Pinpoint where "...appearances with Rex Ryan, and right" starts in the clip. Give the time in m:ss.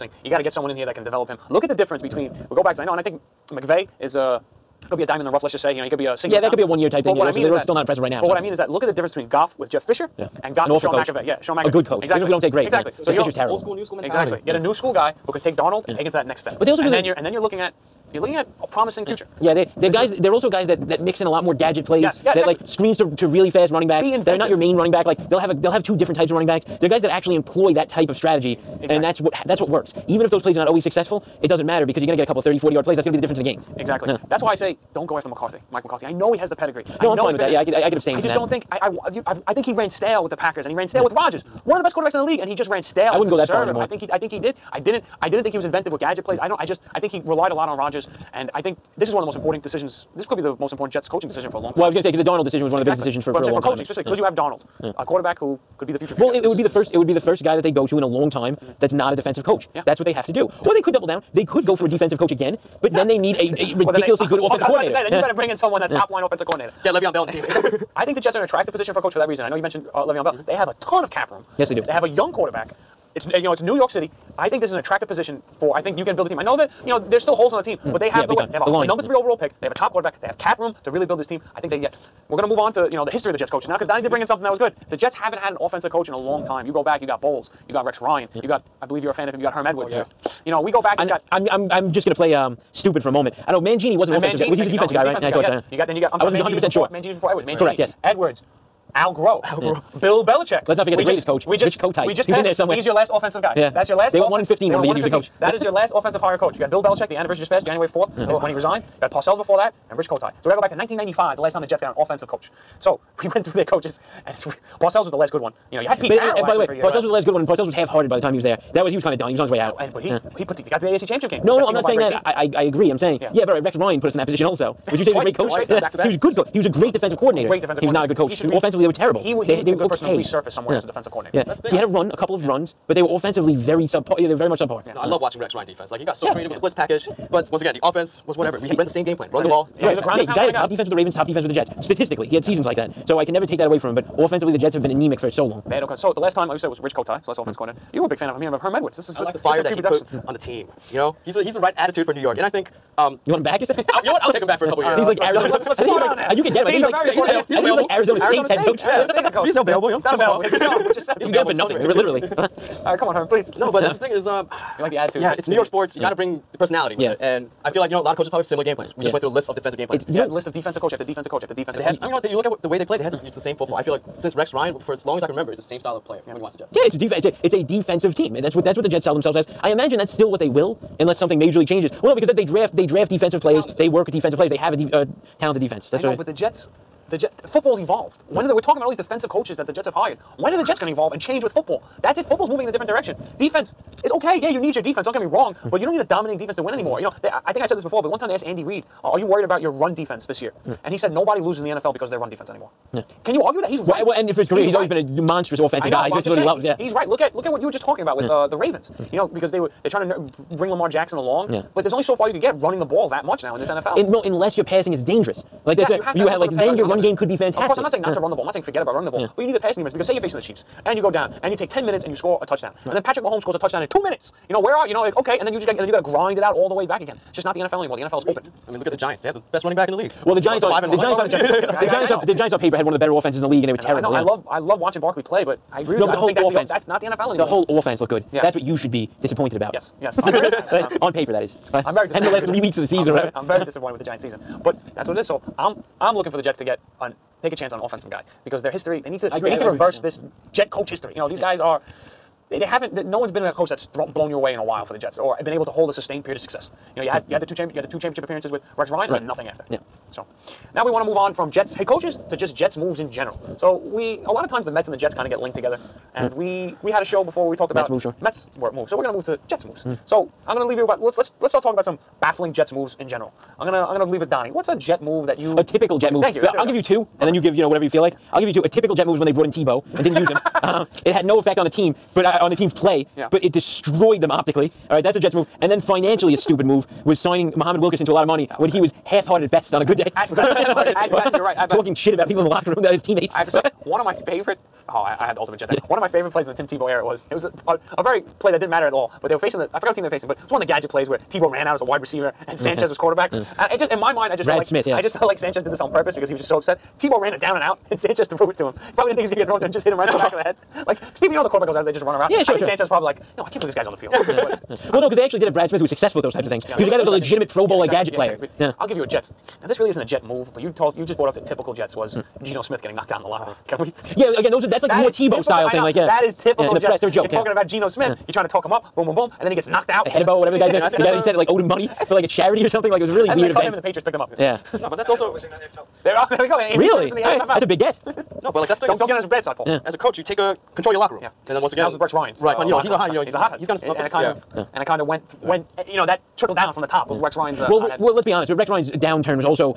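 4:18.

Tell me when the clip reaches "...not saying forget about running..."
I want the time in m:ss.
3:38.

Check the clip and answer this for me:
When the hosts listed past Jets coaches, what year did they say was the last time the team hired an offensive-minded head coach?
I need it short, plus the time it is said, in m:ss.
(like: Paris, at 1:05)
1995, at 1:50.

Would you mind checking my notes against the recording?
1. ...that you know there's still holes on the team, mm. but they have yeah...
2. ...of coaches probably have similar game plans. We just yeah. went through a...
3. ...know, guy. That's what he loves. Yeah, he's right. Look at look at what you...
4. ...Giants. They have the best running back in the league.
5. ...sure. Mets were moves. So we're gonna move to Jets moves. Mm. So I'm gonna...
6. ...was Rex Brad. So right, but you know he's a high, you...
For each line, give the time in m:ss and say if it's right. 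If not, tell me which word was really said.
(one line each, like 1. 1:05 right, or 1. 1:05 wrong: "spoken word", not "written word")
1. 1:16 right
2. 2:48 right
3. 3:25 right
4. 3:48 right
5. 4:28 right
6. 5:41 wrong: "Ryan", not "Brad".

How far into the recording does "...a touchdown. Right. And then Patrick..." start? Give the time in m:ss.
3:42.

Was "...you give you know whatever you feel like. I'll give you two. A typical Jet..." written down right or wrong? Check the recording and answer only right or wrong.
right.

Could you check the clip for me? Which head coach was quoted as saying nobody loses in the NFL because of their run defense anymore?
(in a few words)
Andy Reid.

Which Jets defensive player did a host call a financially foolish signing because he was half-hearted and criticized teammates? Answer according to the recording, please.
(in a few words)
Muhammad Wilkerson.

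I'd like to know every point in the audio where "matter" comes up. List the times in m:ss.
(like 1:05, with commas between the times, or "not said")
0:31, 4:58.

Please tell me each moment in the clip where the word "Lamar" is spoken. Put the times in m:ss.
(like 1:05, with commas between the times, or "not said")
3:30.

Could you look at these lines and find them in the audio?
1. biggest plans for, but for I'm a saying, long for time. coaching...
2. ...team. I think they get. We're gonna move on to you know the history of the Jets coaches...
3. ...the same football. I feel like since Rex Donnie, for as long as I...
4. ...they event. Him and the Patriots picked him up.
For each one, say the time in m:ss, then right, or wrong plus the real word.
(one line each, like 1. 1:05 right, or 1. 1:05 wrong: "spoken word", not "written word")
1. 0:52 wrong: "decisions", not "plans"
2. 1:21 right
3. 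2:53 wrong: "Ryan", not "Donnie"
4. 5:33 right.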